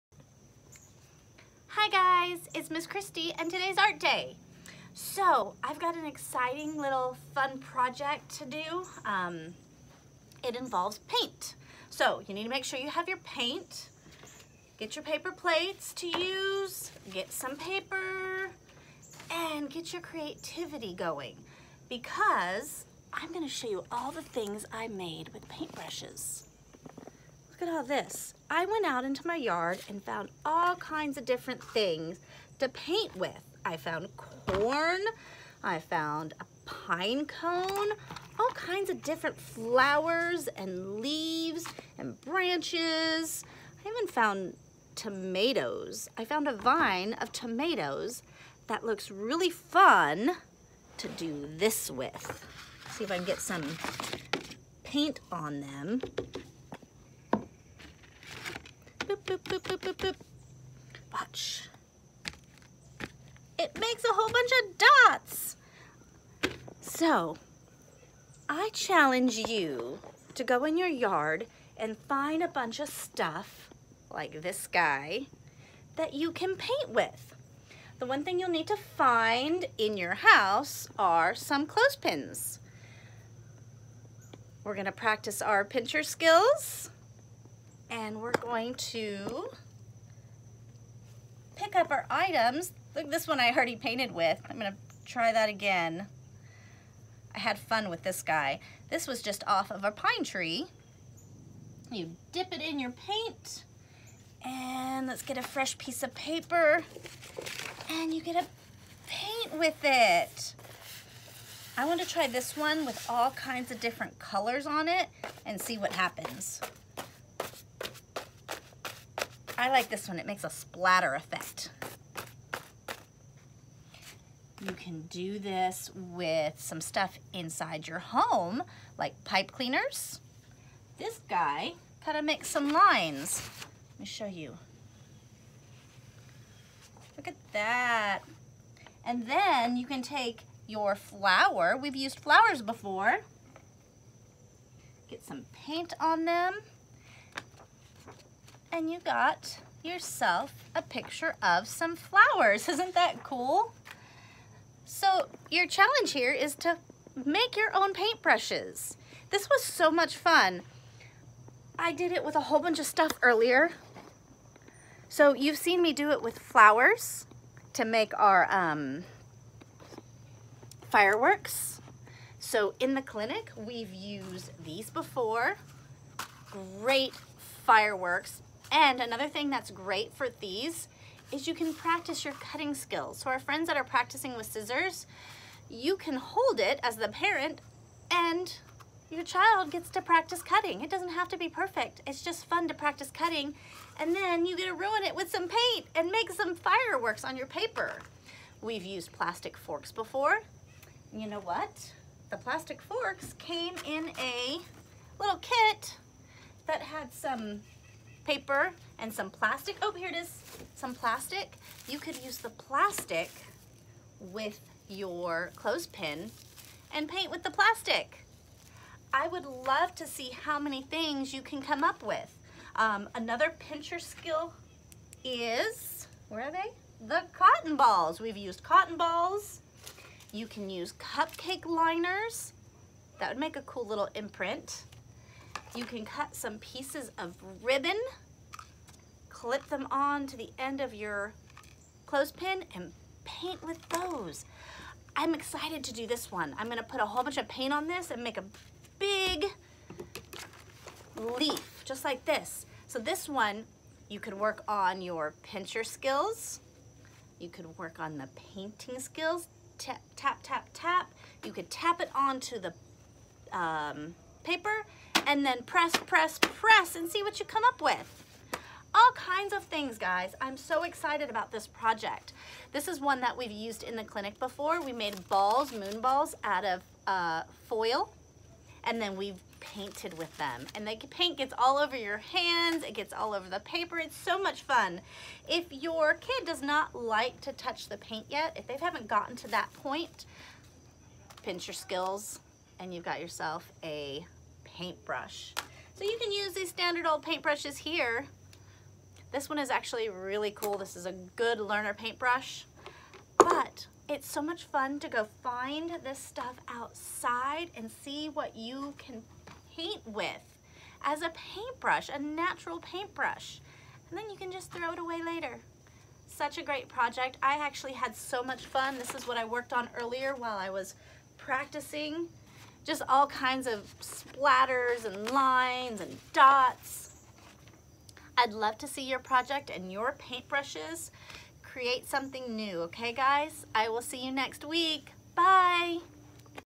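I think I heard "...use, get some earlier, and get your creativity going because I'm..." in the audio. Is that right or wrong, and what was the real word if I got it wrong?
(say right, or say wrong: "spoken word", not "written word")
wrong: "paper", not "earlier".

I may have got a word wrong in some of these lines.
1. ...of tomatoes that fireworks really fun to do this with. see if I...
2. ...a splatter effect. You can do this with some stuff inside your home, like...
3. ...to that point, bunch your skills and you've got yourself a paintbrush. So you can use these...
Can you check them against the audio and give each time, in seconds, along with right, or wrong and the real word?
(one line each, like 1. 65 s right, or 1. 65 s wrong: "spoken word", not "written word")
1. 47 s wrong: "looks", not "fireworks"
2. 120 s right
3. 289 s wrong: "pinch", not "bunch".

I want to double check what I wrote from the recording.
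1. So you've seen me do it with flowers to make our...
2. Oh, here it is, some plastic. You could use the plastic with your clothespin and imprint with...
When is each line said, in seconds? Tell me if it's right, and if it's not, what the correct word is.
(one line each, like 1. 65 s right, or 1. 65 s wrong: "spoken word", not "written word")
1. 165 s right
2. 209 s wrong: "paint", not "imprint".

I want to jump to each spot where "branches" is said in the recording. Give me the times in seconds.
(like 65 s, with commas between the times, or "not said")
42 s.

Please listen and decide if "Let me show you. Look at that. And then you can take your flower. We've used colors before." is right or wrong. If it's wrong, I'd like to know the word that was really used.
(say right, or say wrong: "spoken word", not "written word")
wrong: "flowers", not "colors".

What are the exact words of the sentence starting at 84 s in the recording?
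We're gonna practice our pincher skills and we're going to pick up our items.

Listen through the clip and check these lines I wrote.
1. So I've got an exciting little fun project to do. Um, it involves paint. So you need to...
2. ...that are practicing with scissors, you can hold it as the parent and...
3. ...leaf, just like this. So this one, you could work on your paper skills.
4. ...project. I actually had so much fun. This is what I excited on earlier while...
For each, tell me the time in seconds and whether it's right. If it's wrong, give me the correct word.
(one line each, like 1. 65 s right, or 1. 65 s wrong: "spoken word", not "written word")
1. 4 s right
2. 183 s right
3. 251 s wrong: "pincher", not "paper"
4. 316 s wrong: "worked", not "excited".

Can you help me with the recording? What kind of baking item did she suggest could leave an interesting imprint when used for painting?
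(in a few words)
cupcake liners.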